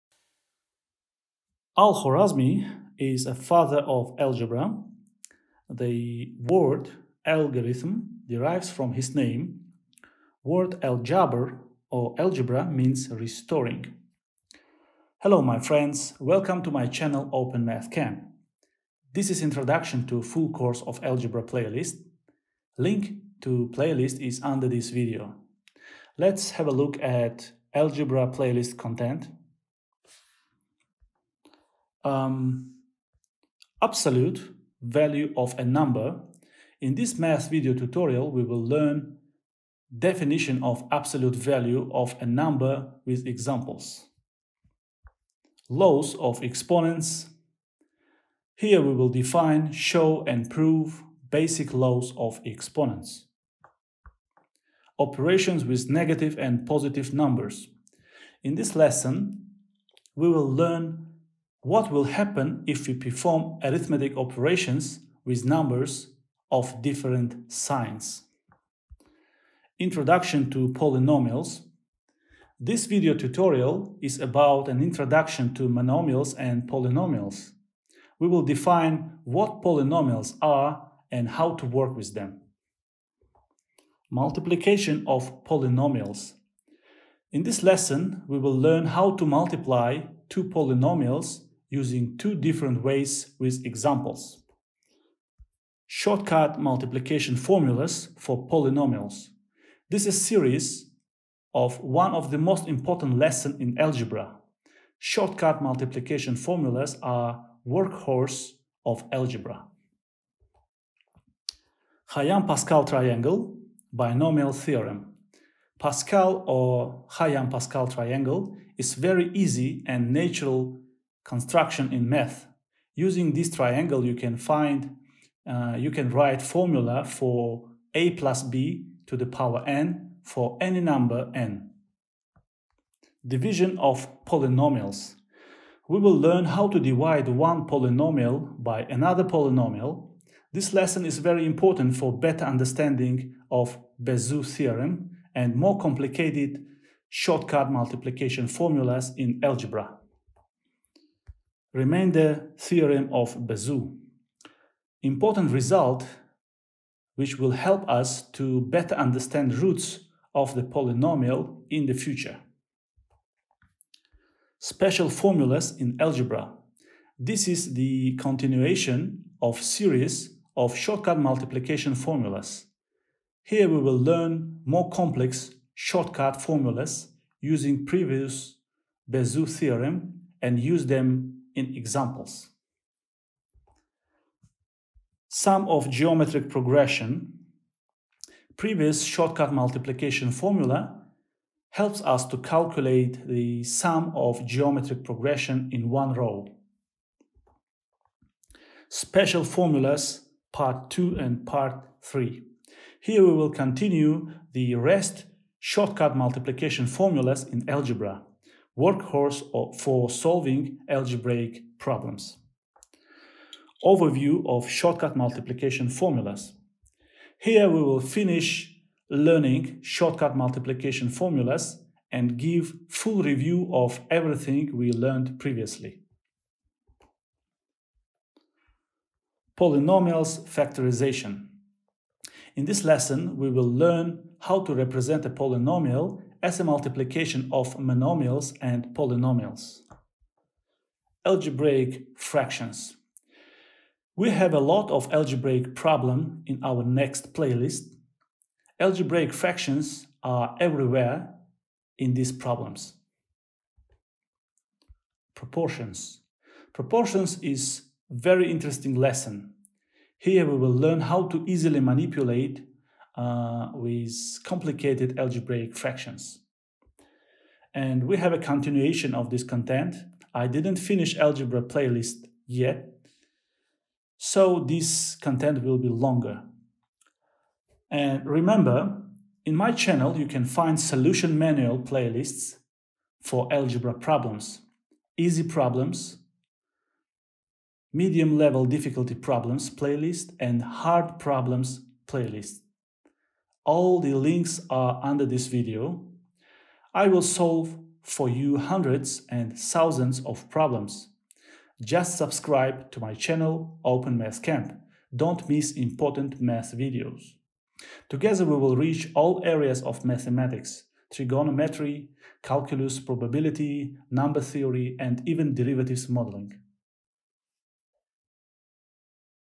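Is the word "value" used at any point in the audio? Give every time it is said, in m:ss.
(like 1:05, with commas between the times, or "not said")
0:34, 0:41.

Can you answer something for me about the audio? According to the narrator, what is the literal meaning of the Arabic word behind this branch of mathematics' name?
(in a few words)
restoring.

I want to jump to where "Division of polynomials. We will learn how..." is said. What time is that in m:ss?
2:13.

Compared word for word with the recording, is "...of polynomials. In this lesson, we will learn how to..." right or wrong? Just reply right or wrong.
right.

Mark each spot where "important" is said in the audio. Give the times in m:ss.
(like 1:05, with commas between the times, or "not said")
1:42, 2:21, 2:35, 5:05.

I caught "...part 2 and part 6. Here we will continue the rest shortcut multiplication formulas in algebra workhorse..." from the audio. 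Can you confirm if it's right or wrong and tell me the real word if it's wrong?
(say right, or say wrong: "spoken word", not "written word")
wrong: "3", not "6".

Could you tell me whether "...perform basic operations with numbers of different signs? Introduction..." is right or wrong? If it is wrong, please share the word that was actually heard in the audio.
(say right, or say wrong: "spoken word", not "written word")
wrong: "arithmetic", not "basic".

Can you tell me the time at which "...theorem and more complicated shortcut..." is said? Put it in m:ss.
2:24.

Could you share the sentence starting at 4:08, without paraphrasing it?
Algebraic fractions are everywhere in these problems.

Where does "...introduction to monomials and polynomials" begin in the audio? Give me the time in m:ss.
1:14.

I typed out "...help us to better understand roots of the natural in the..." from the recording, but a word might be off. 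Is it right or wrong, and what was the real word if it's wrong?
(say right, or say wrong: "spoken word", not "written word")
wrong: "polynomial", not "natural".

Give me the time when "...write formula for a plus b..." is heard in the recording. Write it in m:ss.
2:06.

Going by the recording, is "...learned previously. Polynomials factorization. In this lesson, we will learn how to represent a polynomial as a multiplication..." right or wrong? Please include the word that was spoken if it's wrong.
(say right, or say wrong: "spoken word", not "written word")
right.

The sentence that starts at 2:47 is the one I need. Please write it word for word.
This is the continuation of series of shortcut multiplication formulas.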